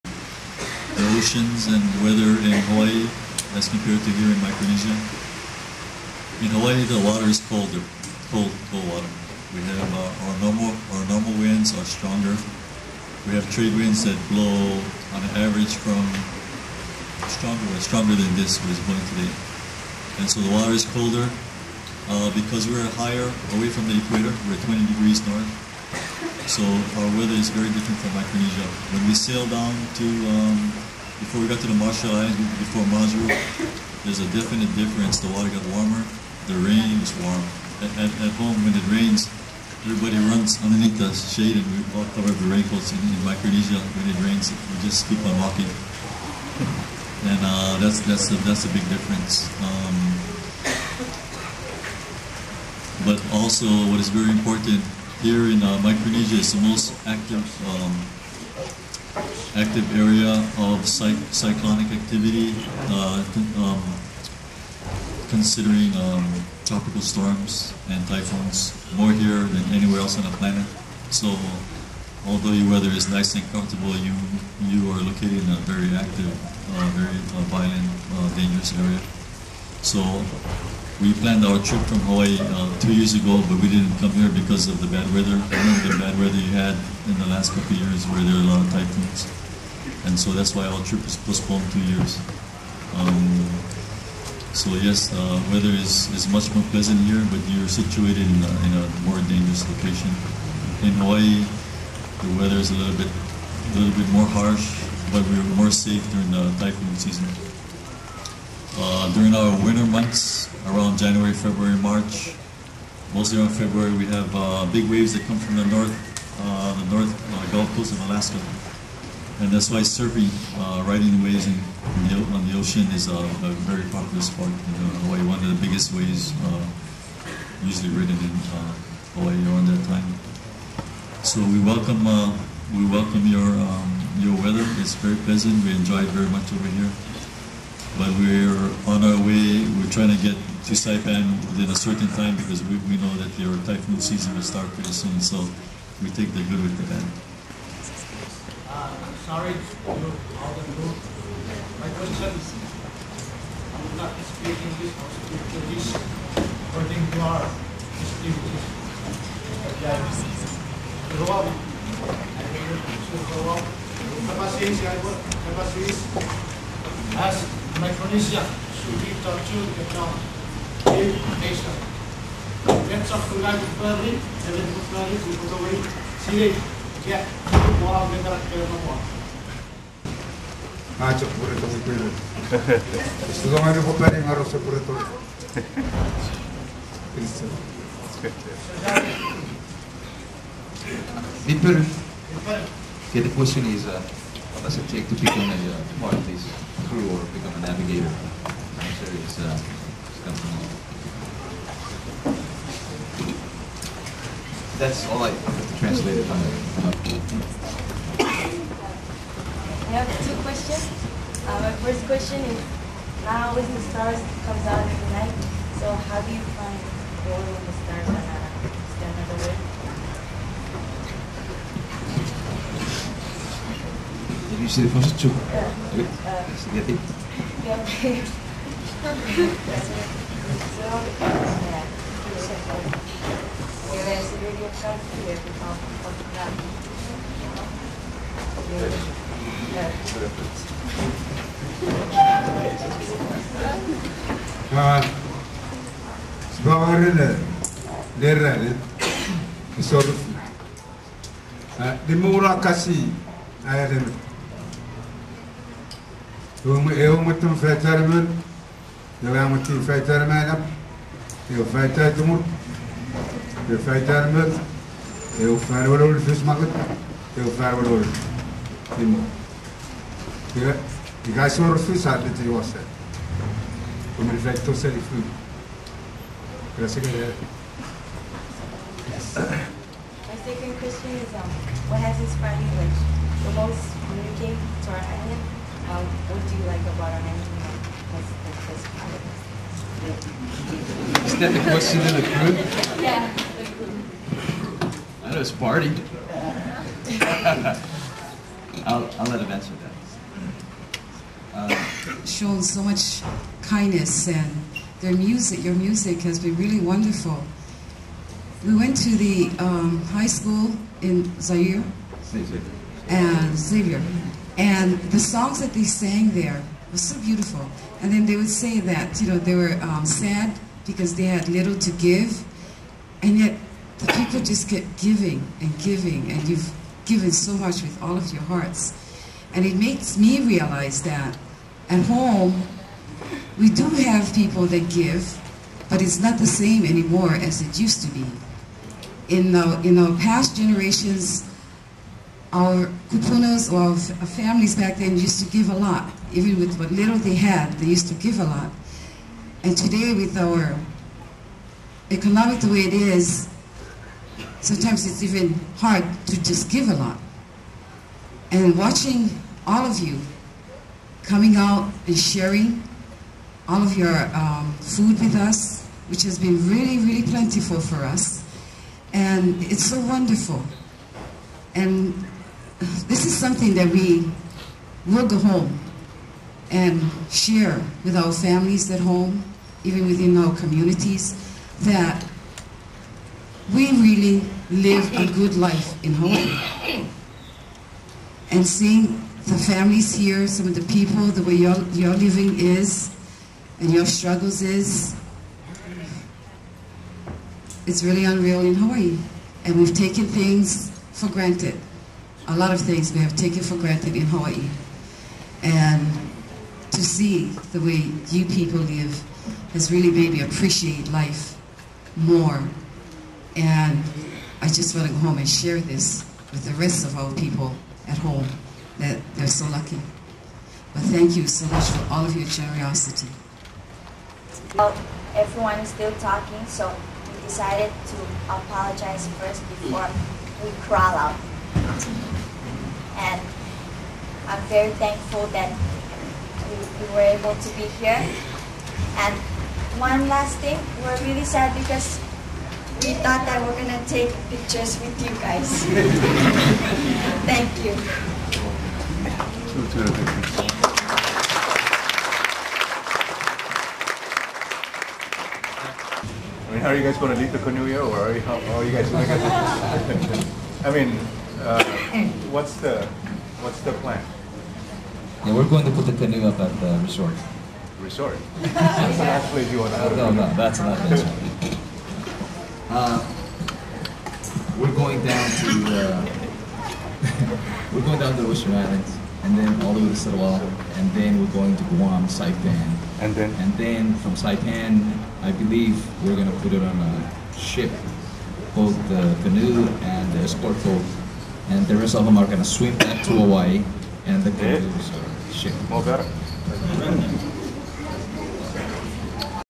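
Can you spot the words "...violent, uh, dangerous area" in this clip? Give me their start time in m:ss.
1:17.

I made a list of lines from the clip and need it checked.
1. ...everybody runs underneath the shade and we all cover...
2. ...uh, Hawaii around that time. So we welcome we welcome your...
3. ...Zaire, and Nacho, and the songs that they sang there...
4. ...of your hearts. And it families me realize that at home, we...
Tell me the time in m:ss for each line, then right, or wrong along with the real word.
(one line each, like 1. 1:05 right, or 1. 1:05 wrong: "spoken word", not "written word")
1. 0:39 right
2. 2:08 right
3. 5:11 wrong: "Xavier", not "Nacho"
4. 5:28 wrong: "makes", not "families".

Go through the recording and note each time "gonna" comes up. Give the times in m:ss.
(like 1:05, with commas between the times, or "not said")
7:23.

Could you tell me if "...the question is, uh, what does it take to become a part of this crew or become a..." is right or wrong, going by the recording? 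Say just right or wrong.
right.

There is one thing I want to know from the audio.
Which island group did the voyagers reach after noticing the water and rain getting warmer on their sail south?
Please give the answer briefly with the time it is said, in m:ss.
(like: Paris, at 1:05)
Marshall Islands, at 0:31.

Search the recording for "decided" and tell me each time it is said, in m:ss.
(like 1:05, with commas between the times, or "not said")
7:07.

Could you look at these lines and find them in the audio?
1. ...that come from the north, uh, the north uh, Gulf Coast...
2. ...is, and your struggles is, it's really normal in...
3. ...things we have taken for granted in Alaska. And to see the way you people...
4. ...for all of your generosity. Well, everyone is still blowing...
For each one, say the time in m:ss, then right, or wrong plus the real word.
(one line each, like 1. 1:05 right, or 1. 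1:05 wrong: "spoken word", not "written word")
1. 1:55 right
2. 6:32 wrong: "unreal", not "normal"
3. 6:42 wrong: "Hawaii", not "Alaska"
4. 7:01 wrong: "talking", not "blowing".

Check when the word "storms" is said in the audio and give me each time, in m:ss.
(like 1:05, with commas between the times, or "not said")
1:07.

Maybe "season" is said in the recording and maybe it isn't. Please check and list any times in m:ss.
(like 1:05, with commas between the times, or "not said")
1:46, 2:23.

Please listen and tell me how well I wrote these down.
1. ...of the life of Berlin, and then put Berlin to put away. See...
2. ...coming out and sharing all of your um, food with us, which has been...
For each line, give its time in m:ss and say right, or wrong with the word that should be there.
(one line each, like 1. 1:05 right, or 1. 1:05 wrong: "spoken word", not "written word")
1. 2:53 right
2. 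6:01 right.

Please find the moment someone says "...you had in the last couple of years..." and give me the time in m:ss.
1:26.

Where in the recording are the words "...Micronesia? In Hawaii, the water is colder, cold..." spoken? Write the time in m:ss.
0:04.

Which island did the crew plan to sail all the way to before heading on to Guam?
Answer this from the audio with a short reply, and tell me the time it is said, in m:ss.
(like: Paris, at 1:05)
Satawal, at 8:00.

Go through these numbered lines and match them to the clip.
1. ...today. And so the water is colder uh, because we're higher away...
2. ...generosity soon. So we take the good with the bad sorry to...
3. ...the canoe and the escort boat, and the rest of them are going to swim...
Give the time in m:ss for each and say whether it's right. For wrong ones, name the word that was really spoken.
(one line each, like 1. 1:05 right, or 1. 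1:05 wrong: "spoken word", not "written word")
1. 0:19 right
2. 2:24 wrong: "pretty", not "generosity"
3. 8:09 right.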